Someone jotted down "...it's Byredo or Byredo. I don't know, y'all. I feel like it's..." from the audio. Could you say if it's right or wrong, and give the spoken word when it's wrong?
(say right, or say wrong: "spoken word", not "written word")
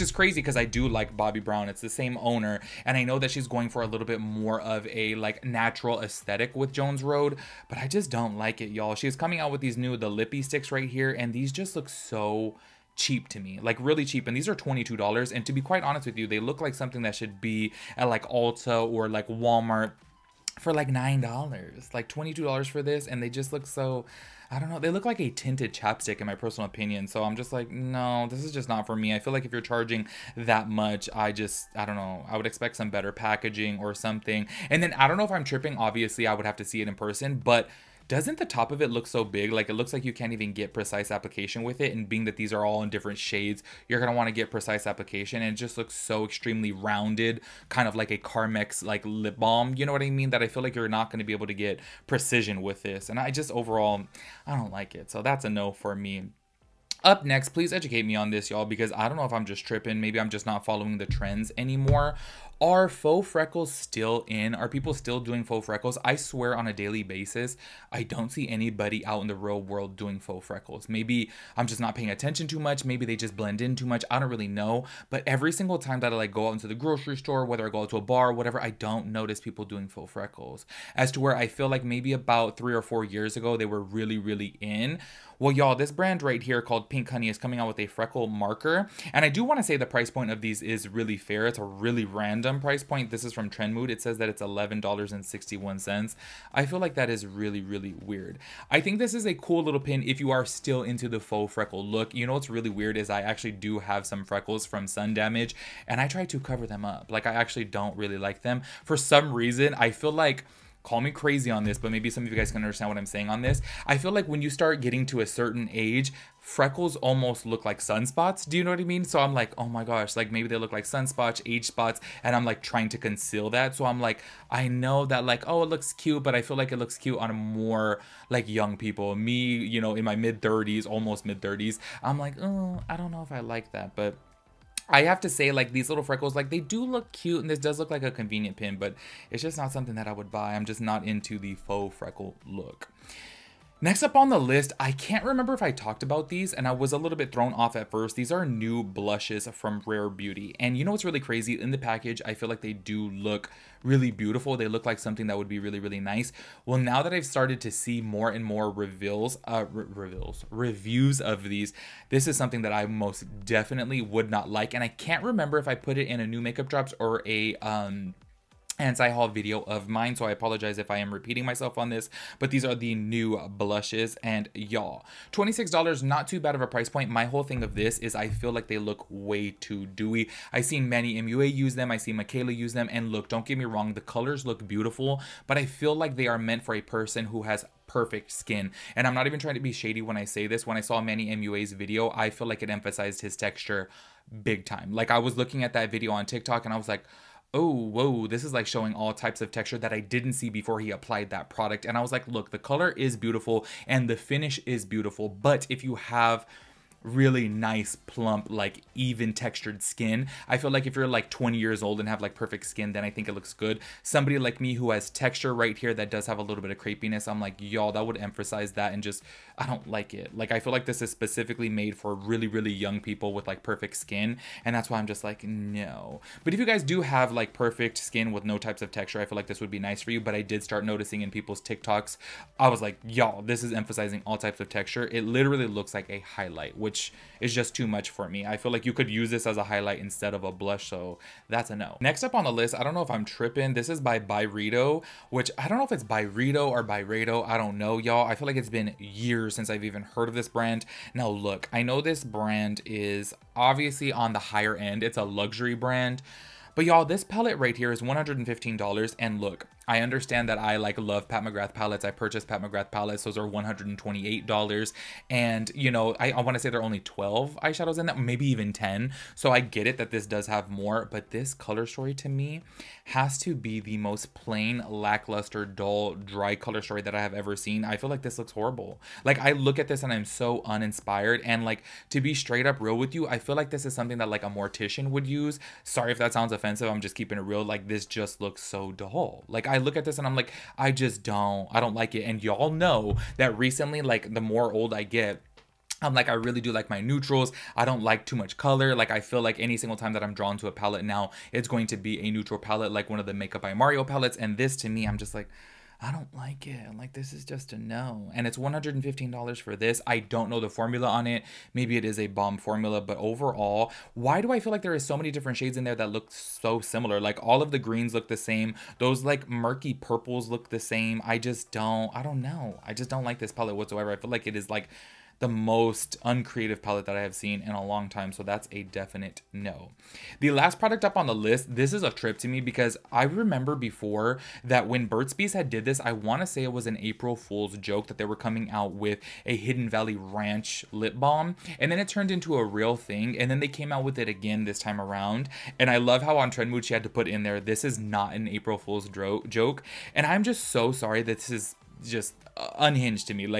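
right.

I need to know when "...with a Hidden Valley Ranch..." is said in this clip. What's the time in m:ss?
5:38.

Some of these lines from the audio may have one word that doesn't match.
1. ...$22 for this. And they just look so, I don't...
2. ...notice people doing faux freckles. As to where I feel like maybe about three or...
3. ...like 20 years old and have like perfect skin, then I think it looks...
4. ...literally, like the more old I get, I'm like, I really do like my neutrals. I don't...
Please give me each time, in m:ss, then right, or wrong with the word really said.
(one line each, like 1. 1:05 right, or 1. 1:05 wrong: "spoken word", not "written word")
1. 0:22 right
2. 1:19 right
3. 3:31 right
4. 4:53 wrong: "recently", not "literally".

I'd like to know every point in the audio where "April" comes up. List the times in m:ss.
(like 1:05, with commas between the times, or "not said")
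5:36, 5:48.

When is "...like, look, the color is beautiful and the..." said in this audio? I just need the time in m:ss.
3:22.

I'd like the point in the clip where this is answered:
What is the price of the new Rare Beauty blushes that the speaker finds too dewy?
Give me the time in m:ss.
2:55.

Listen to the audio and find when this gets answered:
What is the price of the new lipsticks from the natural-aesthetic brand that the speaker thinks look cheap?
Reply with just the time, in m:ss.
0:14.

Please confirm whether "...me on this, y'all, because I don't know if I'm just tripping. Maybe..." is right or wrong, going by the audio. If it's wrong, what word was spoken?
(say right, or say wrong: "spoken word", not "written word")
right.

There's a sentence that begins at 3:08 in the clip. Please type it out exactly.
And I'm not even trying to be shady when I say this.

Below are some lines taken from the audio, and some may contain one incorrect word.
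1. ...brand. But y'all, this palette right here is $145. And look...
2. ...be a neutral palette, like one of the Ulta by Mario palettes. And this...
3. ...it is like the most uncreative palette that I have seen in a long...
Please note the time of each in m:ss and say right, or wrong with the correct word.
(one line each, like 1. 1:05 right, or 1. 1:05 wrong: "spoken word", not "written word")
1. 4:15 wrong: "115", not "145"
2. 5:01 wrong: "Makeup", not "Ulta"
3. 5:24 right.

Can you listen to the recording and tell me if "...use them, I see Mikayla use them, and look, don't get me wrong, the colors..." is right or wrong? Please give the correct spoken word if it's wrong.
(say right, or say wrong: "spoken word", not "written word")
right.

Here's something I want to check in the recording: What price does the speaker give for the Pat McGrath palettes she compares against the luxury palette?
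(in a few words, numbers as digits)
$128.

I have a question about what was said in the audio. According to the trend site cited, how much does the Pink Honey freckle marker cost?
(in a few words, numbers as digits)
$11.61.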